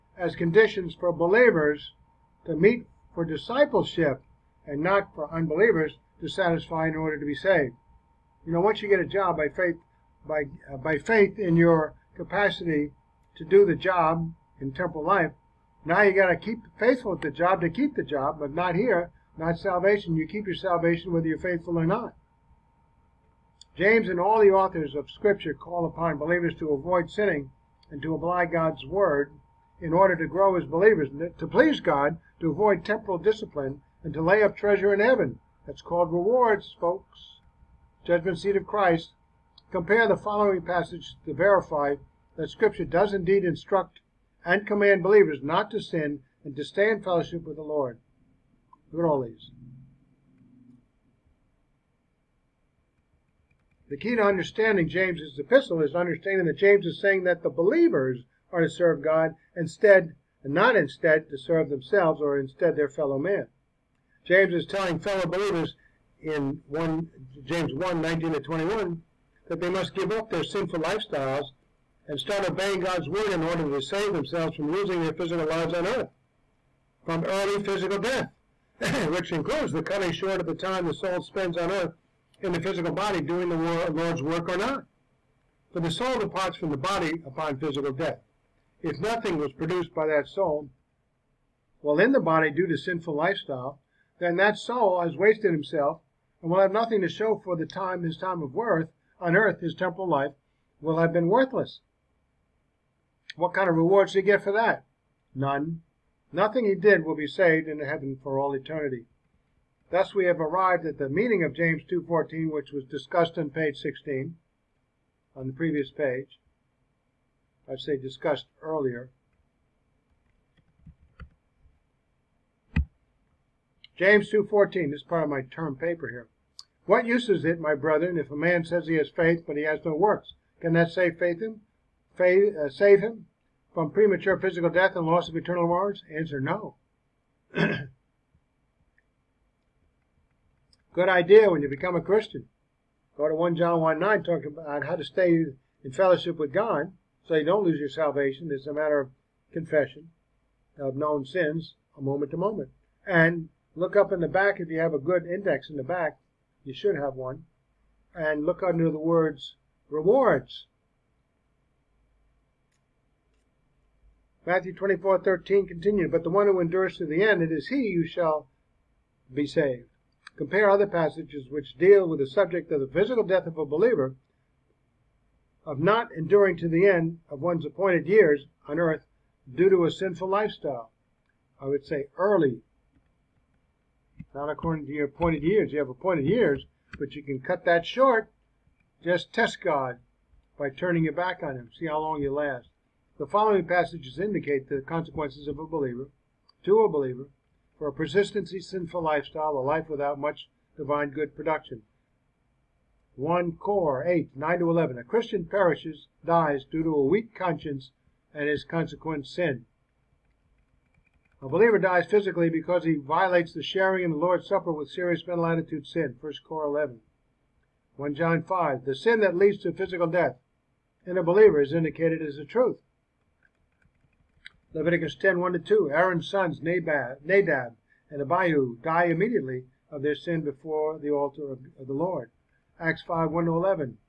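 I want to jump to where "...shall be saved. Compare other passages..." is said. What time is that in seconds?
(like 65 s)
168 s.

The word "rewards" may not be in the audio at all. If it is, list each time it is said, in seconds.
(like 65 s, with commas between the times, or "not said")
36 s, 103 s, 135 s, 159 s.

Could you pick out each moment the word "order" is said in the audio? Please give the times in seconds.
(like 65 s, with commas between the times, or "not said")
6 s, 29 s, 73 s.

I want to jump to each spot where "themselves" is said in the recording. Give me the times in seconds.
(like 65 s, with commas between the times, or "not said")
61 s, 74 s.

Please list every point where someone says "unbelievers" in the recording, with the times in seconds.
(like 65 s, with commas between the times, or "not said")
5 s.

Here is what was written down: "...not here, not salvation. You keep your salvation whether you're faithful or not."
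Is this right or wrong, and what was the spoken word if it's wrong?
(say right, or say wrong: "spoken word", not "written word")
right.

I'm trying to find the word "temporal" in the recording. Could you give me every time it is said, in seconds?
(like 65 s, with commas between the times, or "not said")
14 s, 32 s, 99 s.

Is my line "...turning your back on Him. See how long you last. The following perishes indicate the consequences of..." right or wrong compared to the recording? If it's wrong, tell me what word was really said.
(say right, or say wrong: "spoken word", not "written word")
wrong: "passages", not "perishes".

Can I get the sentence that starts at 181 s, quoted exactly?
I would say early, not according to your appointed years.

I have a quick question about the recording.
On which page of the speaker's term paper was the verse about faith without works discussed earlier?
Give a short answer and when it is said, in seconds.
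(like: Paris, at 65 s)
16, at 113 s.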